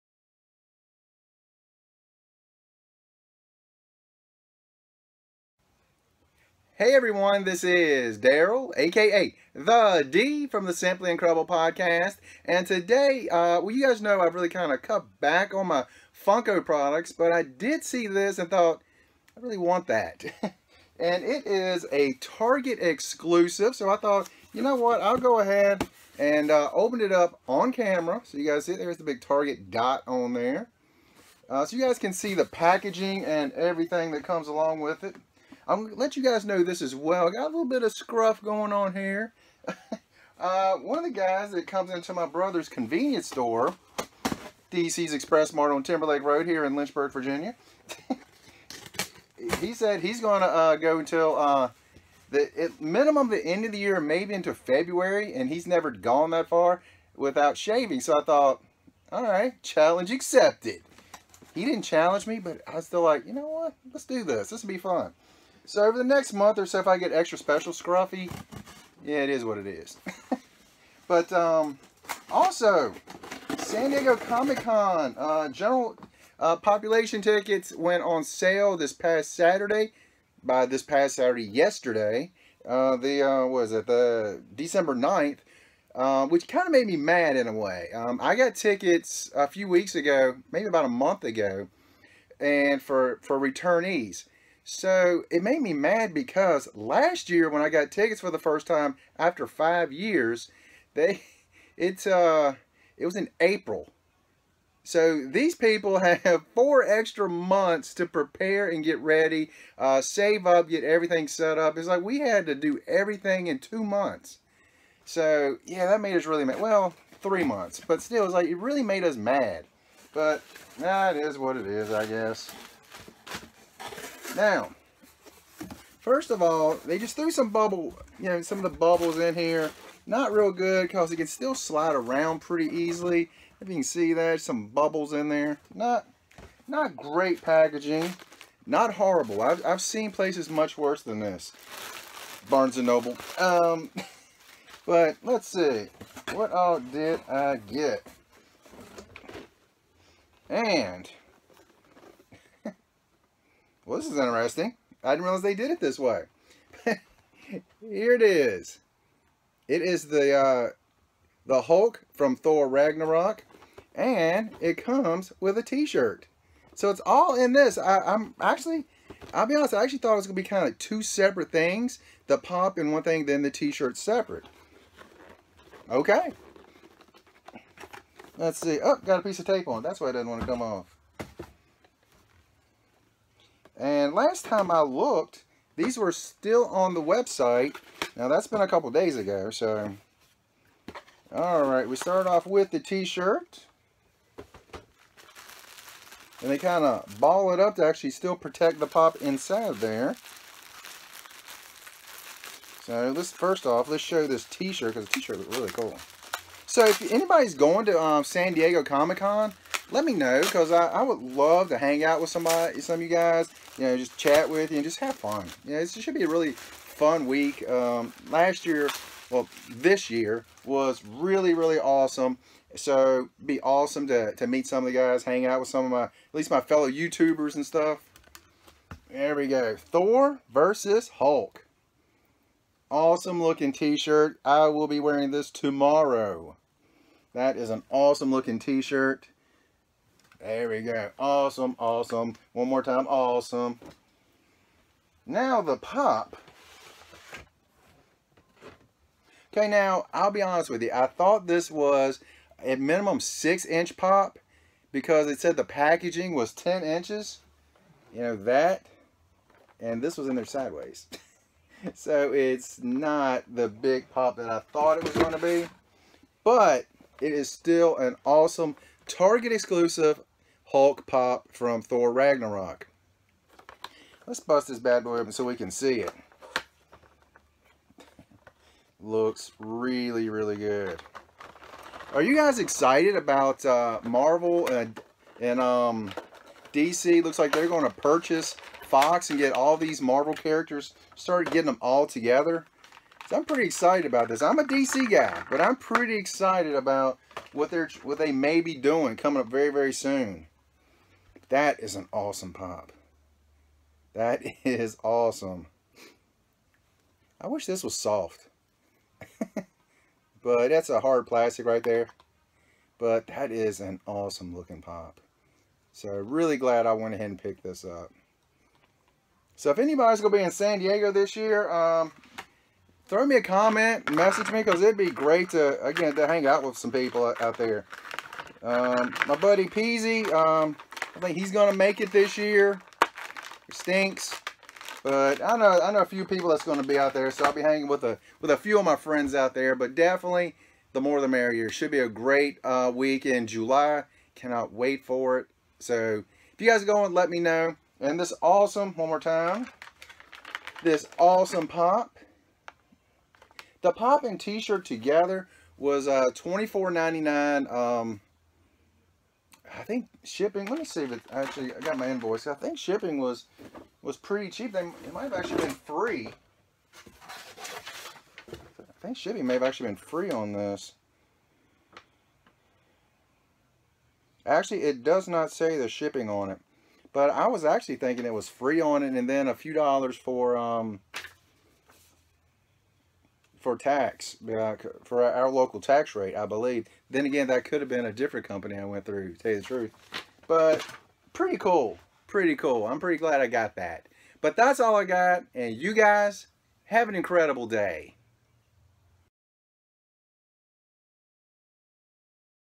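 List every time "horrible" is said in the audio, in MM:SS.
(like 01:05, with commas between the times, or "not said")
02:18.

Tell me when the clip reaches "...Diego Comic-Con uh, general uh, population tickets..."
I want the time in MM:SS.
01:13.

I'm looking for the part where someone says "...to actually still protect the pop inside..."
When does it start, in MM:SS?
03:17.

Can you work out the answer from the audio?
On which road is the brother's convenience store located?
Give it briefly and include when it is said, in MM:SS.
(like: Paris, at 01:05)
Timberlake Road, at 00:45.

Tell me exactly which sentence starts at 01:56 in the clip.
Well, three months, but still, it's like it really made us mad.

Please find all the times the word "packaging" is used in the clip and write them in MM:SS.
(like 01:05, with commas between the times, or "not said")
00:32, 02:17, 04:15.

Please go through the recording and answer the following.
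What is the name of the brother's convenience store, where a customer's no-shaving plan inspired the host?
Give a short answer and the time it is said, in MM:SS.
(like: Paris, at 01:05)
DC's Express Mart, at 00:44.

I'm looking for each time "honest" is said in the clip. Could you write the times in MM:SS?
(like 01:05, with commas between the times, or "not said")
02:49, 04:10.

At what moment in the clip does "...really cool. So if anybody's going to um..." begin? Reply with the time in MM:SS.
03:25.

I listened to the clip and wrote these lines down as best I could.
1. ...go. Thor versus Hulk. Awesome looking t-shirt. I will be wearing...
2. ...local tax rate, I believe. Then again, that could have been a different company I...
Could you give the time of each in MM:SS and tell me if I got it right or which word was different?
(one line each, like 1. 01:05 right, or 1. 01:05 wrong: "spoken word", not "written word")
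1. 03:49 right
2. 06:25 right.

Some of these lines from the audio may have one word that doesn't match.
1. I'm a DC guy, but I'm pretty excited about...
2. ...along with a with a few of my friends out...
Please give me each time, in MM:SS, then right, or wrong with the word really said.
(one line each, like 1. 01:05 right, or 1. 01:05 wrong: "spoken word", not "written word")
1. 04:54 right
2. 05:37 wrong: "hanging", not "along".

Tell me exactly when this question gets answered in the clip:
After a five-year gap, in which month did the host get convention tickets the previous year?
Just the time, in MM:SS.
01:43.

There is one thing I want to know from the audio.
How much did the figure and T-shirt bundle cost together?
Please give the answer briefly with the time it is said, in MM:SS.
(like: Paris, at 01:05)
$24.99, at 05:56.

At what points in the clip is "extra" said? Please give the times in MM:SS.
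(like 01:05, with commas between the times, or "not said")
01:07, 01:46.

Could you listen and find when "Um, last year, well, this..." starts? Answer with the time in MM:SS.
03:37.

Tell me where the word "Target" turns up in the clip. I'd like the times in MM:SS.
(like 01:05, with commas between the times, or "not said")
00:22, 00:29, 04:29.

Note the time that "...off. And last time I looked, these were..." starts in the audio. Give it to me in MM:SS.
03:00.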